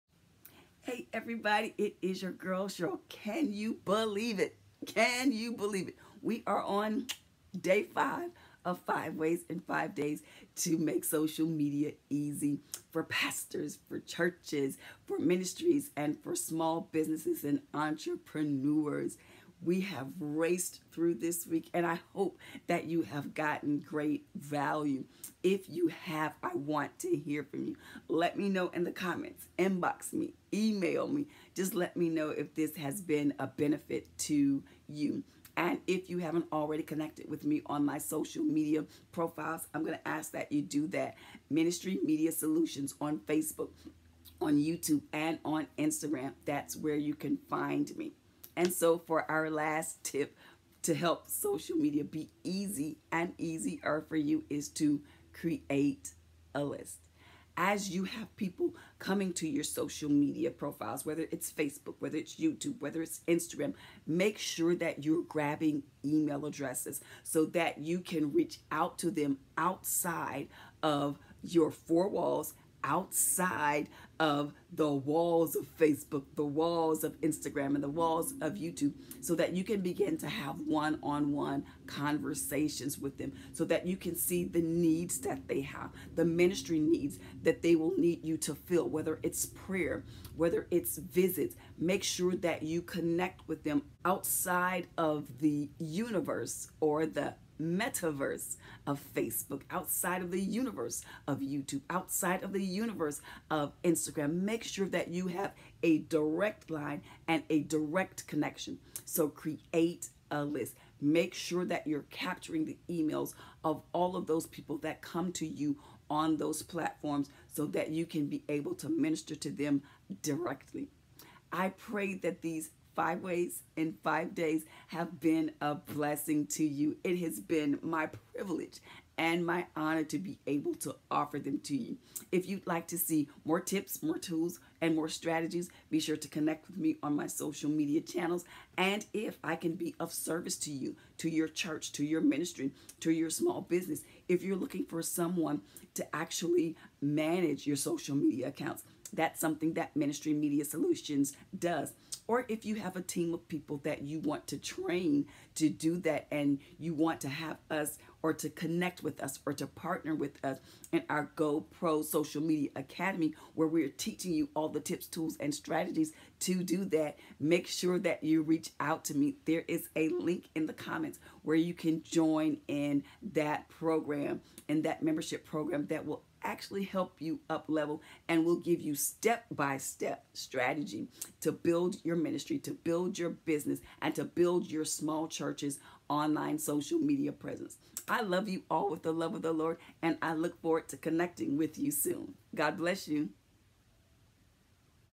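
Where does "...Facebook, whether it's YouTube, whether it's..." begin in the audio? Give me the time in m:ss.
1:01.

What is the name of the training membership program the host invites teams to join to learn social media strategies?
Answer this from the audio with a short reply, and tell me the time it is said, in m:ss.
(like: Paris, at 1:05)
GoPro Social Media Academy, at 2:41.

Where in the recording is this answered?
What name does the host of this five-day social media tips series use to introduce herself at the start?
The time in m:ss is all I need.
0:02.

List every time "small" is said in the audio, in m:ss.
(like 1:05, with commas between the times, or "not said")
0:16, 2:23, 3:04.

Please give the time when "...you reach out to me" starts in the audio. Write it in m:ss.
2:48.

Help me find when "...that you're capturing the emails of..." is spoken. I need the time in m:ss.
1:51.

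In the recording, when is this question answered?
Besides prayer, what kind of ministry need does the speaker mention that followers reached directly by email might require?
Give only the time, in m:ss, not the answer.
1:30.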